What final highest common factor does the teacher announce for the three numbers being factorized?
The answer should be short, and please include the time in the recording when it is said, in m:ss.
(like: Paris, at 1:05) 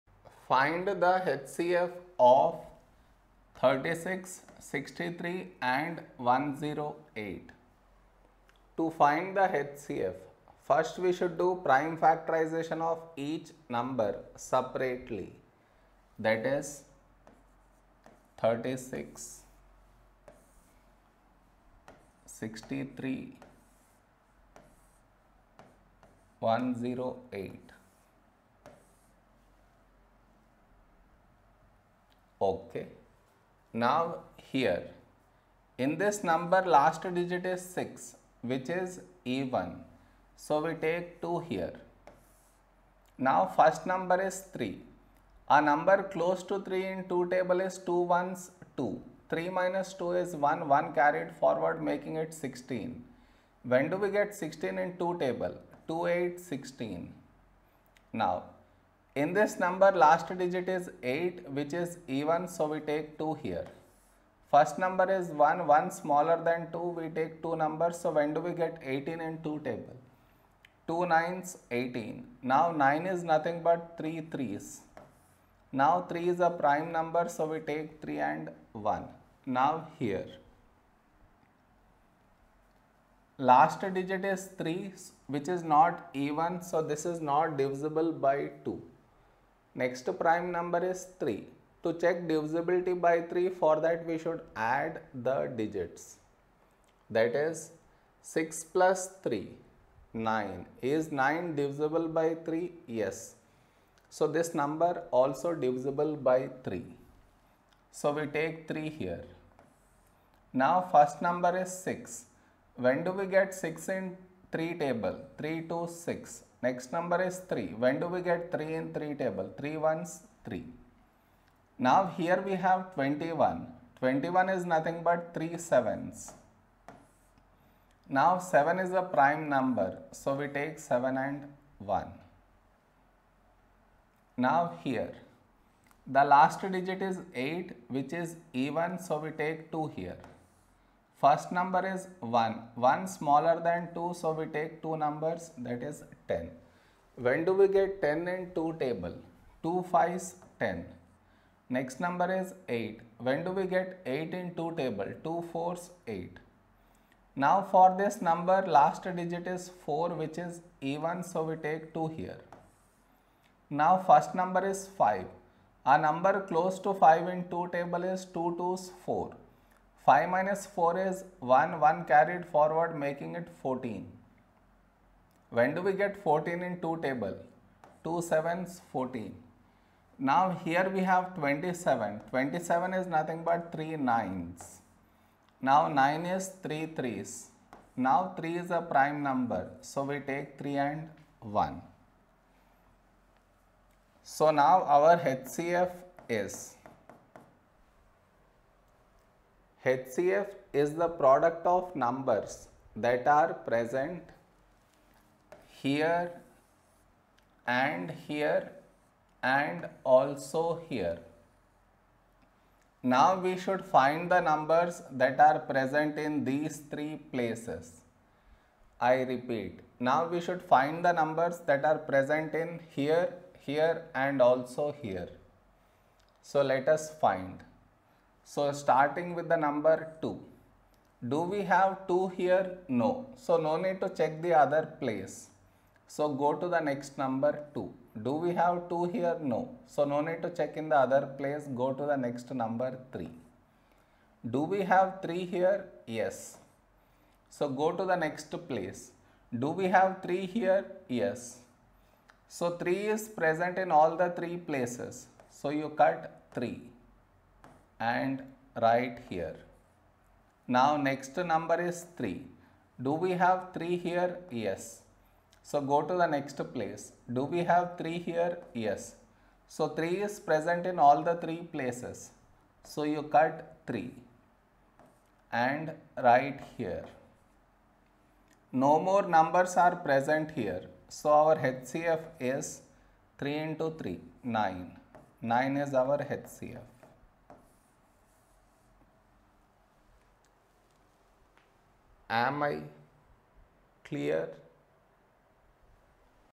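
9, at 4:45.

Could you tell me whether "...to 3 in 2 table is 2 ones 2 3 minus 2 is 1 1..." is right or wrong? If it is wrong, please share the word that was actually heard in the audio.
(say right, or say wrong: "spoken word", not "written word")
right.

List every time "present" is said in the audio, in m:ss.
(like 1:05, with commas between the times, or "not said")
3:23, 3:35, 3:41, 4:13, 4:30, 4:39.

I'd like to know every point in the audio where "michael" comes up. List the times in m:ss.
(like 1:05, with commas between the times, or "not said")
not said.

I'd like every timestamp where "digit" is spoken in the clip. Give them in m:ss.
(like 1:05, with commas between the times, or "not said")
0:37, 1:00, 1:23, 1:35, 2:16, 2:39.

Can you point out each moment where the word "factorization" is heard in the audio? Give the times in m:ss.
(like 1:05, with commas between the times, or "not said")
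0:11.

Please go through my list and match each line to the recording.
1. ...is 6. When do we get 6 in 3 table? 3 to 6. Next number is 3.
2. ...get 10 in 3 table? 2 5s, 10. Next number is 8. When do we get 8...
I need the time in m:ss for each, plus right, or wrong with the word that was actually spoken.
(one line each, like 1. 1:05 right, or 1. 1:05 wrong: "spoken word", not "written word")
1. 1:51 right
2. 2:27 wrong: "2", not "3".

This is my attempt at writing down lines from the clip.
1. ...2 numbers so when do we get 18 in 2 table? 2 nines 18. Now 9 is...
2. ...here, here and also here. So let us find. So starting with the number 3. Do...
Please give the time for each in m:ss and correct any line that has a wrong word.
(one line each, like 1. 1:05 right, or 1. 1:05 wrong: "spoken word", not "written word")
1. 1:07 right
2. 3:42 wrong: "2", not "3".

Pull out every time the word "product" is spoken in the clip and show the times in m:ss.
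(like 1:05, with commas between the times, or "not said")
3:21.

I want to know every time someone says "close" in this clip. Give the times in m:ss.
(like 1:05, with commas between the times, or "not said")
0:46, 2:46.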